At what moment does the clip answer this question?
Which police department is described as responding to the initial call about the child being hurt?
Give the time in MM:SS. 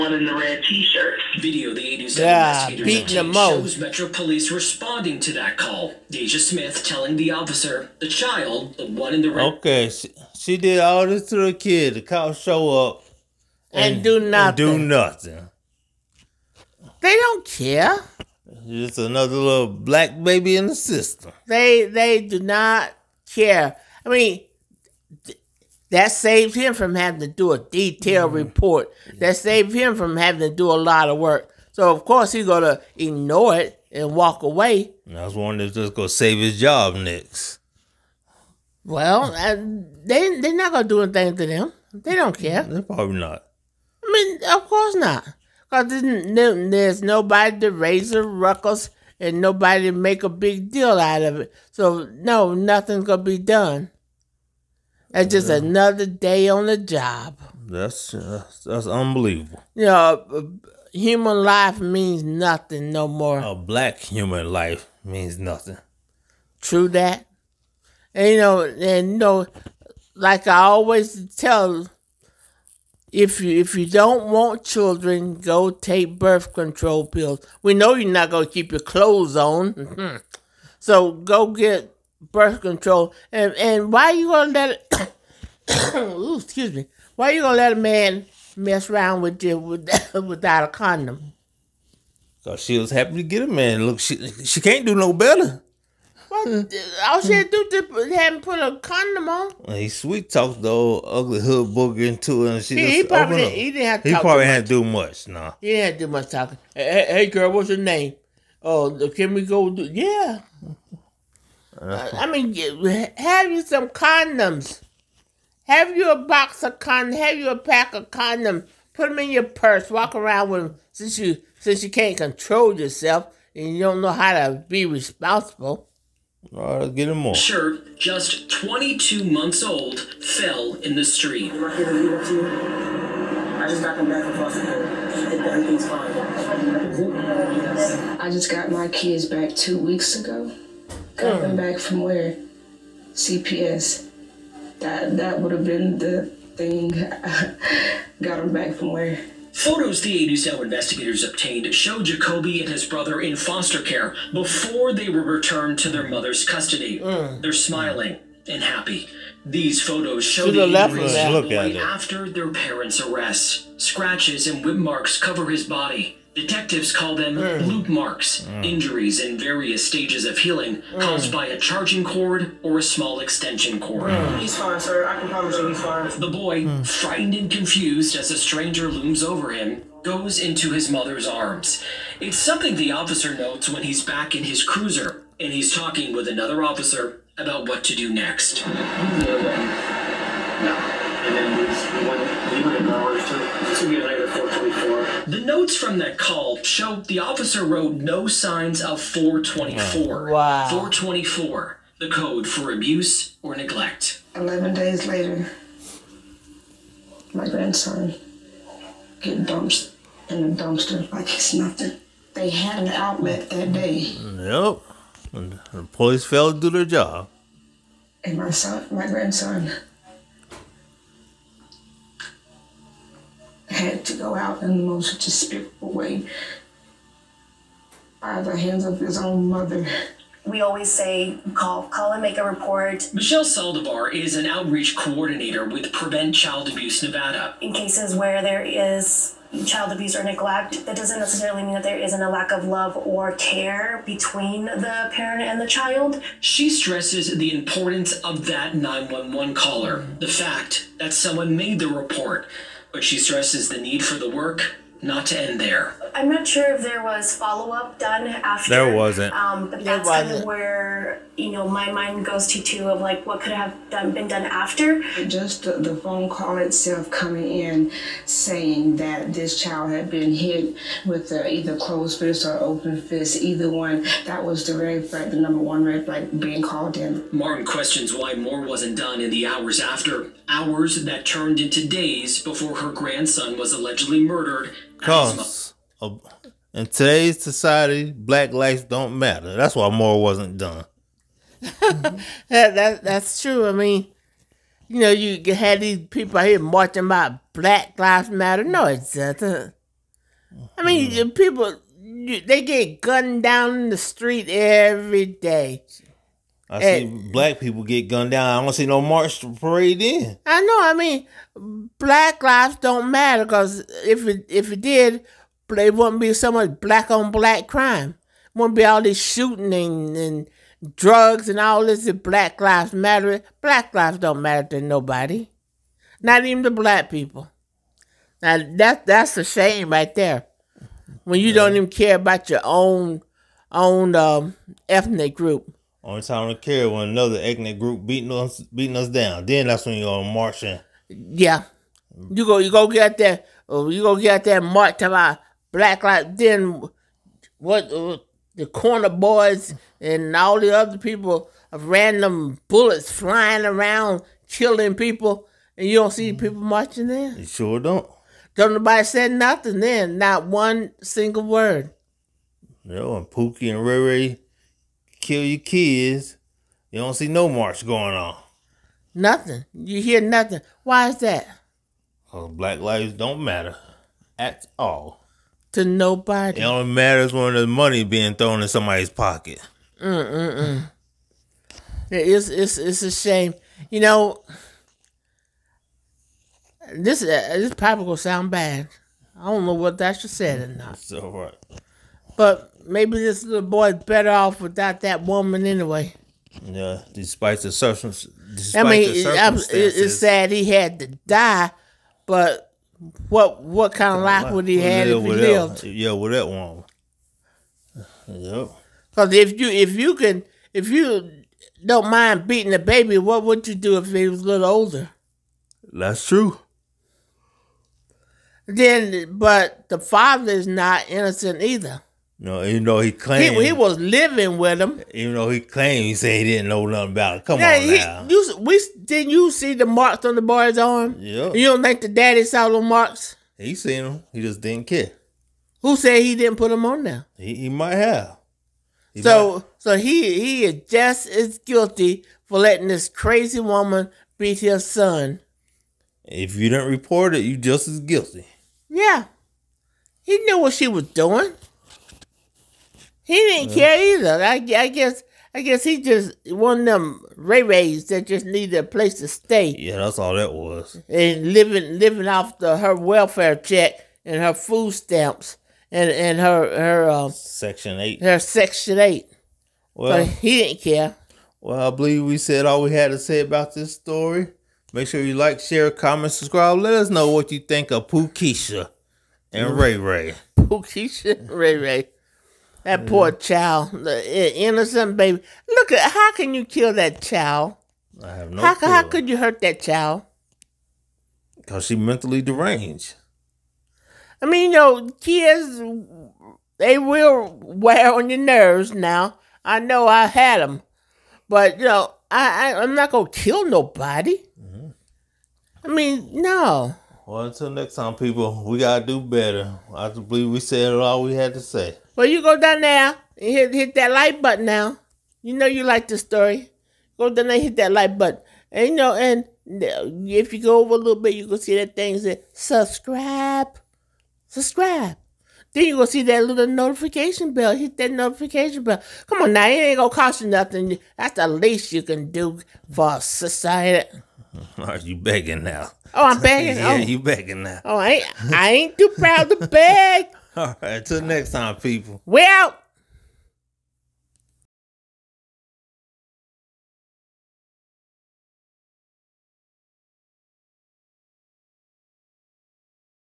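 00:03.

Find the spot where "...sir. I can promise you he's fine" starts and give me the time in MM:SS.
02:54.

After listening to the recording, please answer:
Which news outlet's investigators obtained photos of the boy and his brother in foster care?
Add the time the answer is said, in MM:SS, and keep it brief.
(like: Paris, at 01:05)
8 News Now, at 02:30.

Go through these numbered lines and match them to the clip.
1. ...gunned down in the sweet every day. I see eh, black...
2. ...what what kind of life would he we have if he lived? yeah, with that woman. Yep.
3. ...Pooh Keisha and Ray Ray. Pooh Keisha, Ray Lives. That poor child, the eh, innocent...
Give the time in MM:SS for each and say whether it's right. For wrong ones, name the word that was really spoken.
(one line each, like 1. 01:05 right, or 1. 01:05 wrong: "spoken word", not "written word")
1. 05:03 wrong: "street", not "sweet"
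2. 06:43 right
3. 07:58 wrong: "Ray", not "Lives".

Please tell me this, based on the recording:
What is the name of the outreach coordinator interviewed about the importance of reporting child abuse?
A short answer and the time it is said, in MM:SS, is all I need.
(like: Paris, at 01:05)
Michelle Saldivar, at 03:53.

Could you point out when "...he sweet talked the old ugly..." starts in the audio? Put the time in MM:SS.
01:39.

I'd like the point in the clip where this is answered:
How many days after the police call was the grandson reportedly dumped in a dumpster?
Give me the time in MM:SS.
03:24.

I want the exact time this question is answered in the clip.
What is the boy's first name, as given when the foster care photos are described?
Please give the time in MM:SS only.
02:32.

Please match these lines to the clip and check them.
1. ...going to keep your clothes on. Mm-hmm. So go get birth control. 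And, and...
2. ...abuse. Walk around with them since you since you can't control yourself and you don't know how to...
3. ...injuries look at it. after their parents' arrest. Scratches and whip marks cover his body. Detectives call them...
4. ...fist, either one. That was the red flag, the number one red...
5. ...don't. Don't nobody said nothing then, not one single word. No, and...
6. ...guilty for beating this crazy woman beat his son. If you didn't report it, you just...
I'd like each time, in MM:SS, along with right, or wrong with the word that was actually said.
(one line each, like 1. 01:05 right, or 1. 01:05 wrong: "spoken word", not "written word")
1. 01:18 right
2. 01:59 wrong: "purse", not "abuse"
3. 02:40 right
4. 04:33 right
5. 05:57 right
6. 07:21 wrong: "letting", not "beating".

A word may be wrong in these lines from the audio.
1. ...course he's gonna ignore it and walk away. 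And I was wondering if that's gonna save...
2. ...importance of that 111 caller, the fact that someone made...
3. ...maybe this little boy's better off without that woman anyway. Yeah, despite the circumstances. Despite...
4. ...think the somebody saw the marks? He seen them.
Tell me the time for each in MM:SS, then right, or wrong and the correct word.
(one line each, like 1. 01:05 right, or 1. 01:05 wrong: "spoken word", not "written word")
1. 00:32 right
2. 04:07 wrong: "911", not "111"
3. 06:32 right
4. 07:11 wrong: "daddy", not "somebody".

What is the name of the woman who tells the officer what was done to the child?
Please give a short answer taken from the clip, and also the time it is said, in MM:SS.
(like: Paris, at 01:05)
Deja Smith, at 00:06.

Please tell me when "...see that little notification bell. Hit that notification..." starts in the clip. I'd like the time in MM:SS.
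08:46.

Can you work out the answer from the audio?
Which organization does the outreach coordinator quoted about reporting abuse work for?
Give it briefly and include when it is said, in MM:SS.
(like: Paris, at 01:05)
Prevent Child Abuse Nevada, at 03:55.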